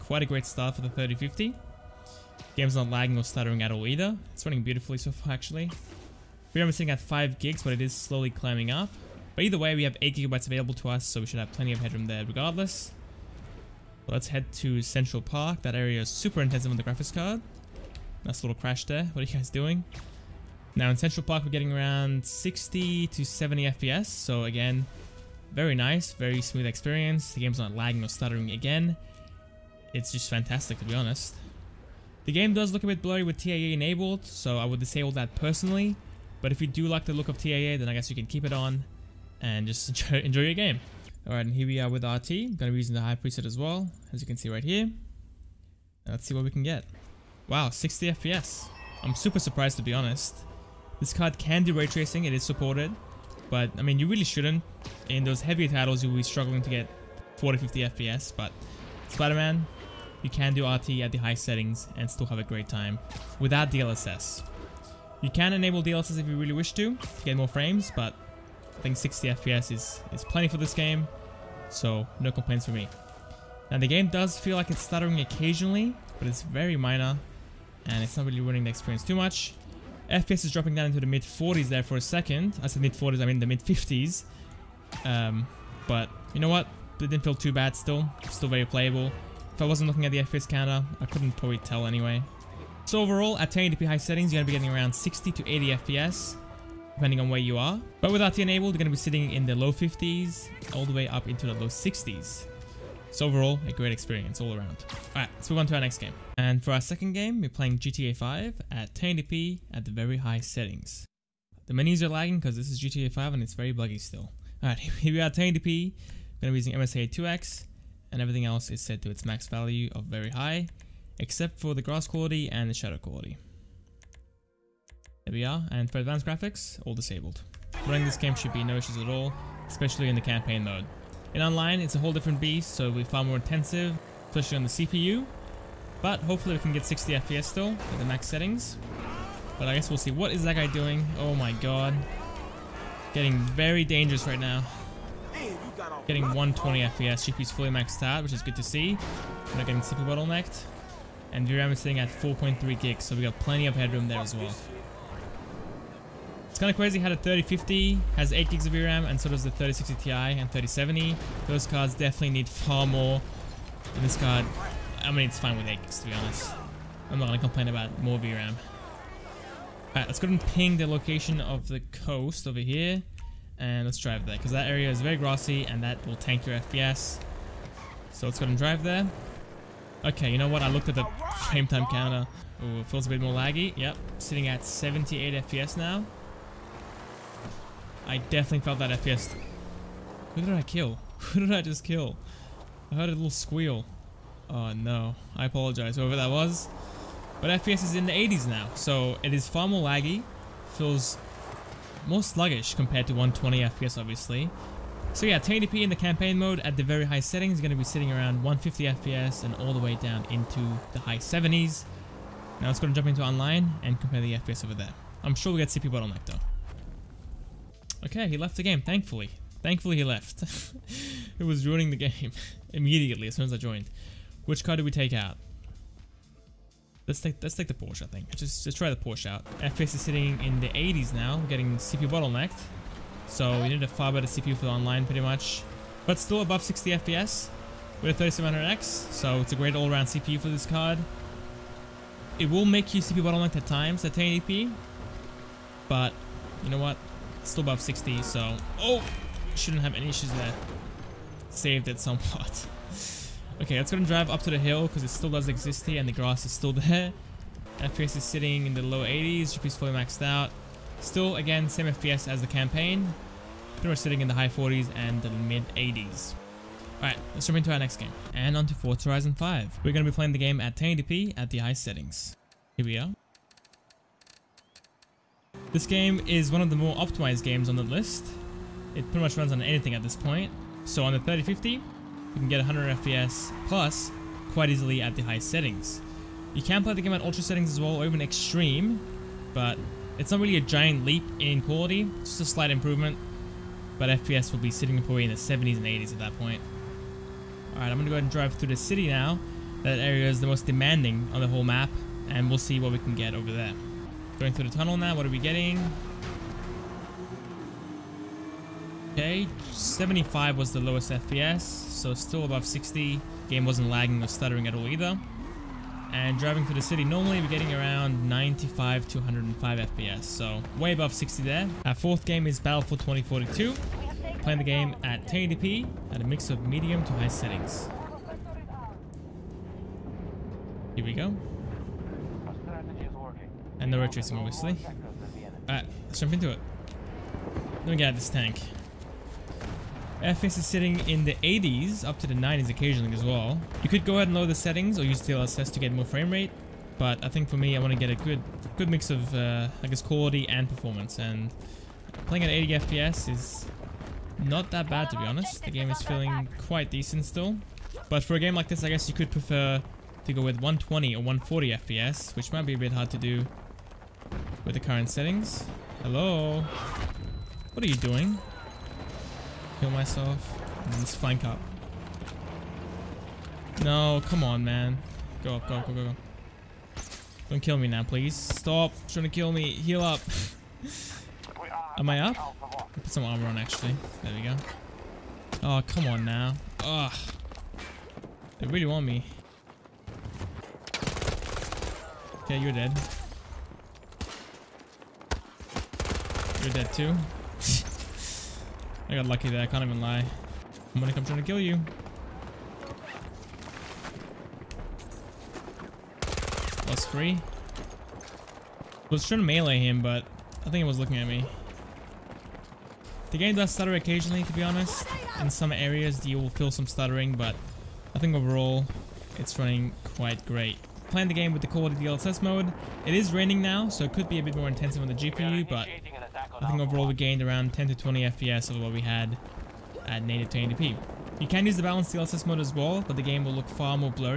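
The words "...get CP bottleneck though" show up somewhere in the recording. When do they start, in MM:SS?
03:35.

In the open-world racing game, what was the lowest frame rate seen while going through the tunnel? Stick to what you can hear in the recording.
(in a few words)
75.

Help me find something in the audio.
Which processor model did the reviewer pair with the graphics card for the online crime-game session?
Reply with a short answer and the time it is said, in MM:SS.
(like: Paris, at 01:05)
3700X, at 03:58.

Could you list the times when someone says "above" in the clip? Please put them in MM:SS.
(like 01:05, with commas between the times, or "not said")
03:56, 04:07, 05:12, 05:20.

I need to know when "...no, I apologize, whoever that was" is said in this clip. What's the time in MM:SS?
03:14.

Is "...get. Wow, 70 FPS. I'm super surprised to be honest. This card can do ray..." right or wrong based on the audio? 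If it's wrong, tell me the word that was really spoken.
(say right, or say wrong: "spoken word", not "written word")
wrong: "60", not "70".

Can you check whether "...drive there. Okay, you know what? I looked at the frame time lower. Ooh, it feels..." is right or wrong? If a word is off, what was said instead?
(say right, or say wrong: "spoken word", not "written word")
wrong: "counter", not "lower".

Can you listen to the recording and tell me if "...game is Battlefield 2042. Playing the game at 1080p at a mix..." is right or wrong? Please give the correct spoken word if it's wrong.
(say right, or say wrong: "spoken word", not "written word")
right.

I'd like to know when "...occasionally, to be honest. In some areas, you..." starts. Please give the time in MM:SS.
06:53.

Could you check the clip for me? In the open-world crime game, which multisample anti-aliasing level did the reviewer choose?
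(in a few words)
MSAA 2X.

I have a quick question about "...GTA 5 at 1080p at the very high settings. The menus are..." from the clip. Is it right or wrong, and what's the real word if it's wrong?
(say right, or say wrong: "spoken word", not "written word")
right.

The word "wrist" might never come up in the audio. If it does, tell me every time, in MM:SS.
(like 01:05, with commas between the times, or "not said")
not said.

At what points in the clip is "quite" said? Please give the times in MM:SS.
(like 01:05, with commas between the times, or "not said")
00:00, 04:44, 05:56, 07:00.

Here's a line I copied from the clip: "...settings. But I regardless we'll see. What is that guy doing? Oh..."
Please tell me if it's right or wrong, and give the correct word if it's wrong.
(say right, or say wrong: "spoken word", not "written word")
wrong: "guess", not "regardless".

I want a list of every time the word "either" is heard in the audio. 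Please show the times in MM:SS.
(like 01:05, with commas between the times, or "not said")
00:03, 00:09, 05:14.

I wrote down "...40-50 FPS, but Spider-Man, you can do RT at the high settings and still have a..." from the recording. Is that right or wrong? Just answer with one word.
right.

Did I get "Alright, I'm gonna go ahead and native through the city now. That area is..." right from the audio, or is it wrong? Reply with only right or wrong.
wrong.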